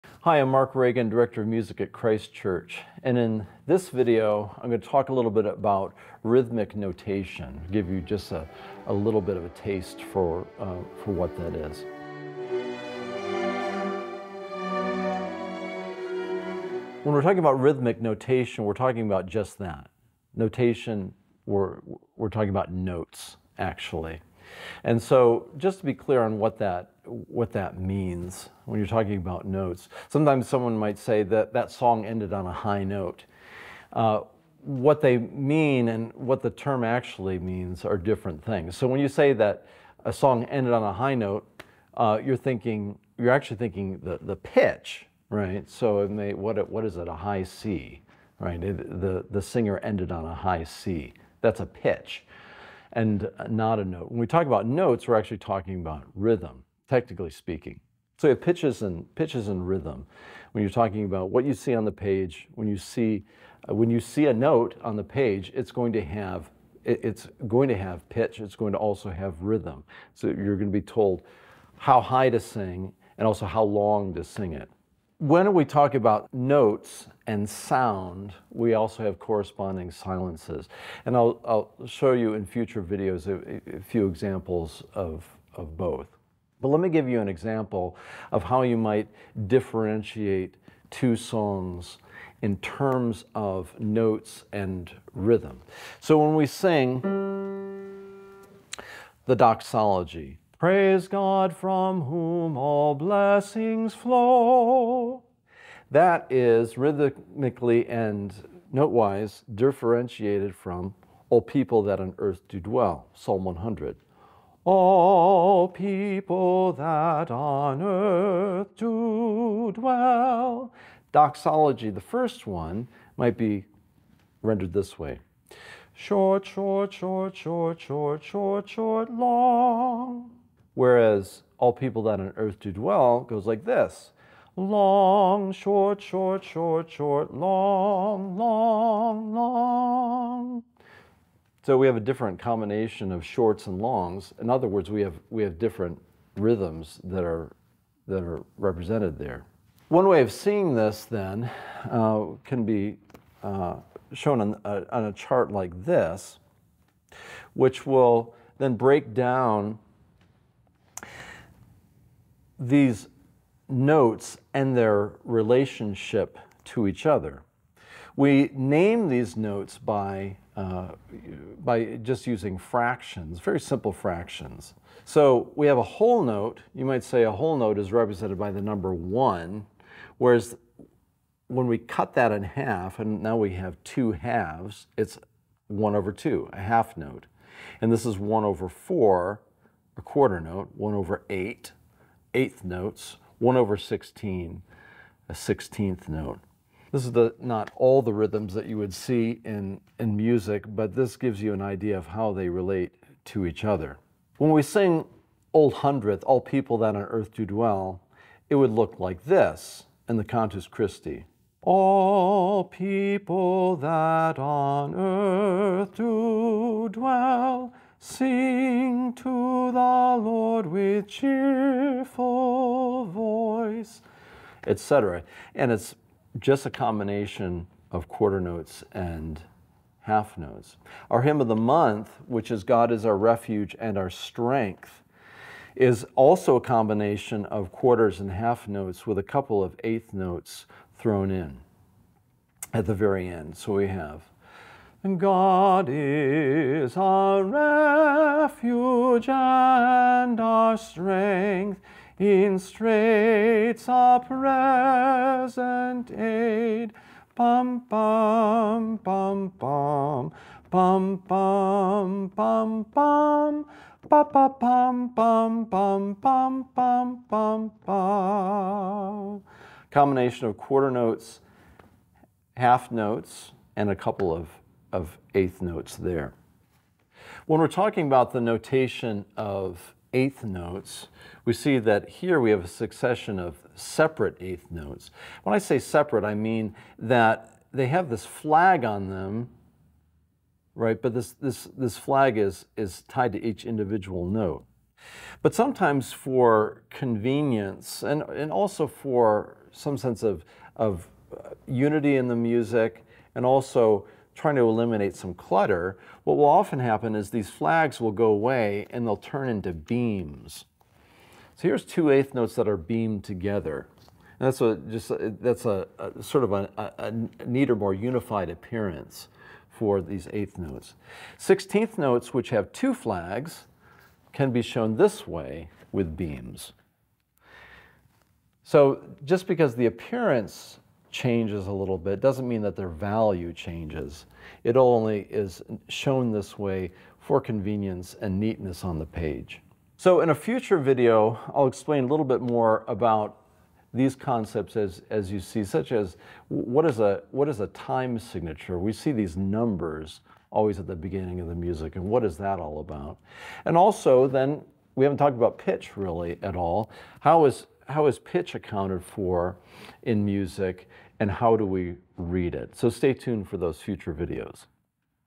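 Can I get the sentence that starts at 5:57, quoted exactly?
How is how is pitch accounted for in music and how do we read it?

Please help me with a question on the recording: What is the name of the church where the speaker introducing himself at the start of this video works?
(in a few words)
Christ Church.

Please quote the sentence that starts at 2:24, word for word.
In other words, we have, we have different rhythms that are, that are represented there.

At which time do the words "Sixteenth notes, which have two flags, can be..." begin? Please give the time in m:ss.
5:21.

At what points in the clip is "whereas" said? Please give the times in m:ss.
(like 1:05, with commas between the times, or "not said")
2:10, 3:00.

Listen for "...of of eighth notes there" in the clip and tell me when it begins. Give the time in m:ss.
4:34.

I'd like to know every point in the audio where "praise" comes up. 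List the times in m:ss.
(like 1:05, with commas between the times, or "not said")
1:40.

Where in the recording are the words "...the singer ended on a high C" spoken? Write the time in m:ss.
0:49.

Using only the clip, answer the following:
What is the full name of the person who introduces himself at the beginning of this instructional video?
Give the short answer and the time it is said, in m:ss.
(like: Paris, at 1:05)
Mark Reagan, at 0:00.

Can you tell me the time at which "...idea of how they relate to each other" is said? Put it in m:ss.
3:21.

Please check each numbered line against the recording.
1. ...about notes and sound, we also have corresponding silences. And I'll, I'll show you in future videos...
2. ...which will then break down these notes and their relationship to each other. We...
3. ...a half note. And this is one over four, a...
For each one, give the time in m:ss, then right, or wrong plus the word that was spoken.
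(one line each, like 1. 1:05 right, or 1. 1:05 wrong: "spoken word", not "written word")
1. 1:15 right
2. 2:37 right
3. 3:06 right.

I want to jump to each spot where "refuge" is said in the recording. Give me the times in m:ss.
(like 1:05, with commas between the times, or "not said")
3:53, 4:07.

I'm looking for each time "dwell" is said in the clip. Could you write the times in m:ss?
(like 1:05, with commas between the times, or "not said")
1:52, 1:59, 2:12, 3:27, 3:36.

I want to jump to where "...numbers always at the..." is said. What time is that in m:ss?
5:49.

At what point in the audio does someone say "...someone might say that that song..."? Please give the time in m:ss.
0:30.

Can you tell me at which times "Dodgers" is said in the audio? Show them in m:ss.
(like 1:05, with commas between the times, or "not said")
not said.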